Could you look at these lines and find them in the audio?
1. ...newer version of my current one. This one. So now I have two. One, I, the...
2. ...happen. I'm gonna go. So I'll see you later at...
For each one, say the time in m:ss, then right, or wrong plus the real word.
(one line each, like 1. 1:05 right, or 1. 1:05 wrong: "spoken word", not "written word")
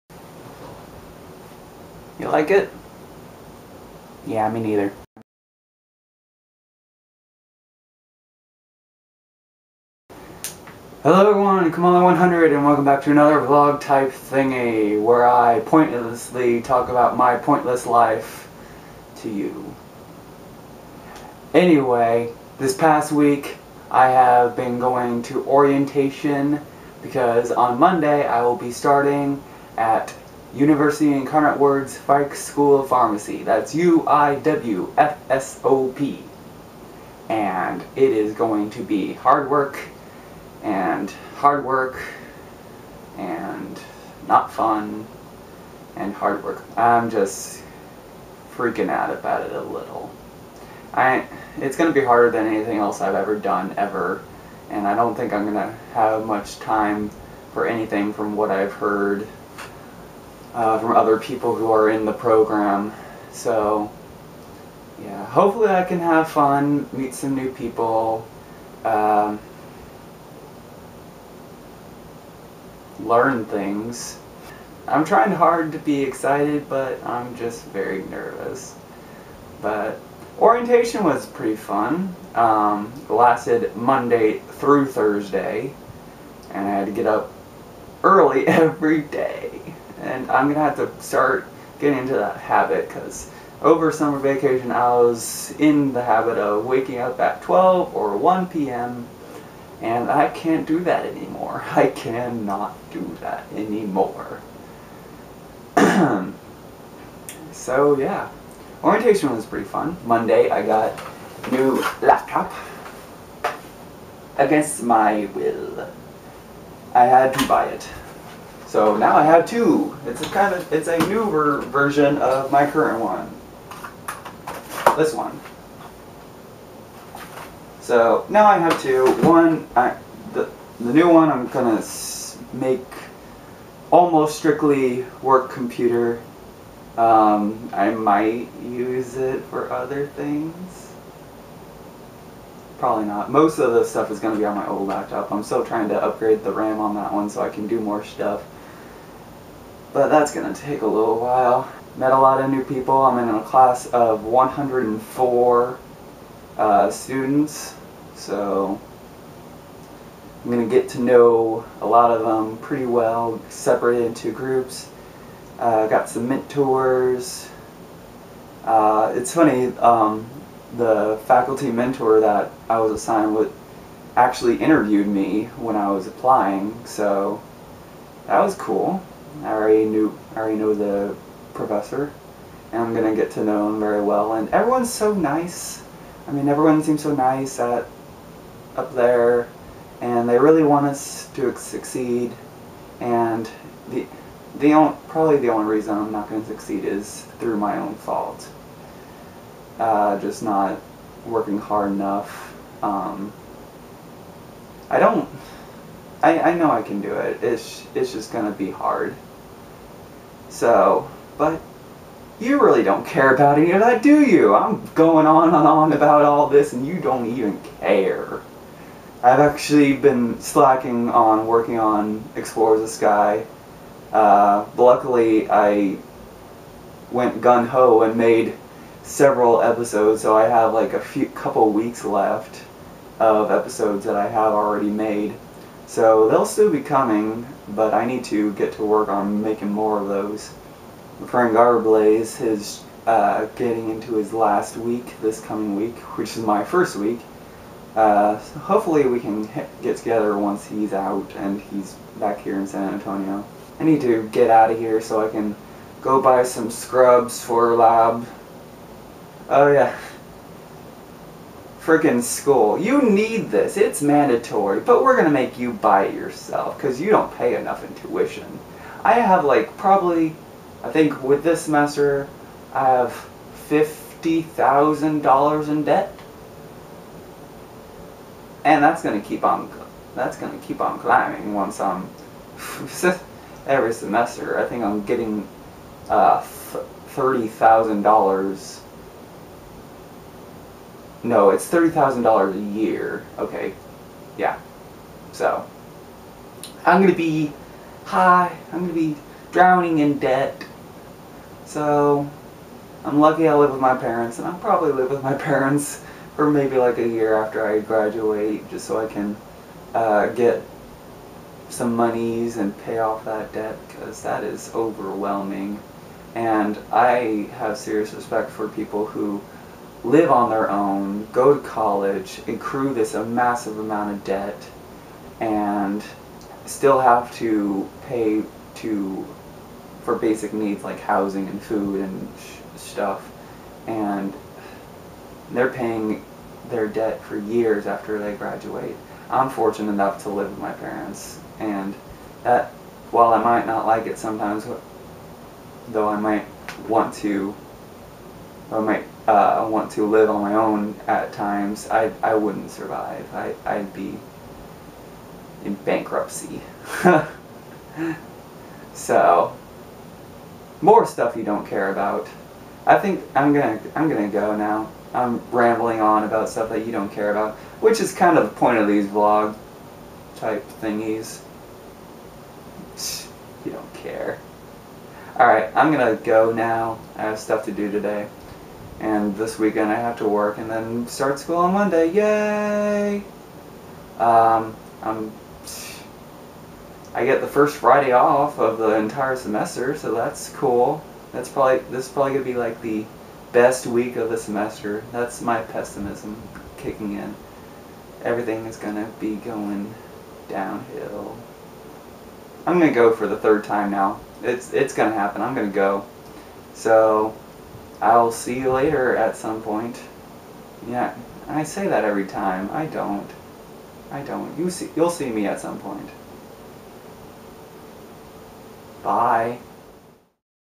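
1. 2:01 right
2. 6:45 right.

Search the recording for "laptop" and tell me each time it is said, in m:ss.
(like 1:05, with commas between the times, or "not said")
1:52, 2:24.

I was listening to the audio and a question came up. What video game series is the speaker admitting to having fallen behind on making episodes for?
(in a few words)
Explorers of Sky.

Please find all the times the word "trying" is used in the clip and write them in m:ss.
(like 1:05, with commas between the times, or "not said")
1:15, 2:25.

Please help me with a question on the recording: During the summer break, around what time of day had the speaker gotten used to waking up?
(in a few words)
12 or 1 p.m.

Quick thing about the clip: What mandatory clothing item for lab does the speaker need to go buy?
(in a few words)
Scrubs.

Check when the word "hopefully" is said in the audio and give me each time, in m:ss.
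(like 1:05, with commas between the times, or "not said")
1:05, 4:08.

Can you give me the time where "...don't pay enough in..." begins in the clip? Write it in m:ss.
4:27.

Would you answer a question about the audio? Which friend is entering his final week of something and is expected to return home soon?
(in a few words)
Frank Garblaze.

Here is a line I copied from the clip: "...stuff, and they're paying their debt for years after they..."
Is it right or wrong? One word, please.
right.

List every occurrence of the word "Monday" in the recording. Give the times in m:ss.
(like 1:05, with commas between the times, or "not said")
0:27, 1:23, 1:50, 6:21.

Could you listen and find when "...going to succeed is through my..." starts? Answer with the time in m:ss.
3:16.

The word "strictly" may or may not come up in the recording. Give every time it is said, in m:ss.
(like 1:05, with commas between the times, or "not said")
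2:14.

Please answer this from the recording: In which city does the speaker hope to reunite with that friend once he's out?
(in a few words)
San Antonio.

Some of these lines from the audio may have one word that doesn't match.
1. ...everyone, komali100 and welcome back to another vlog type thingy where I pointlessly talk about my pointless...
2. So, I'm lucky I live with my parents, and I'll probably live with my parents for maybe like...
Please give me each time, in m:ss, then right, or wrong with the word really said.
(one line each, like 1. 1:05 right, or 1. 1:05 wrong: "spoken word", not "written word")
1. 0:11 right
2. 5:01 right.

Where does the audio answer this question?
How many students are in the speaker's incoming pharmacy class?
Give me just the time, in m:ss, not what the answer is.
2:34.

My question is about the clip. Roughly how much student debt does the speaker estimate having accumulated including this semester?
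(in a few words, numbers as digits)
$50,000.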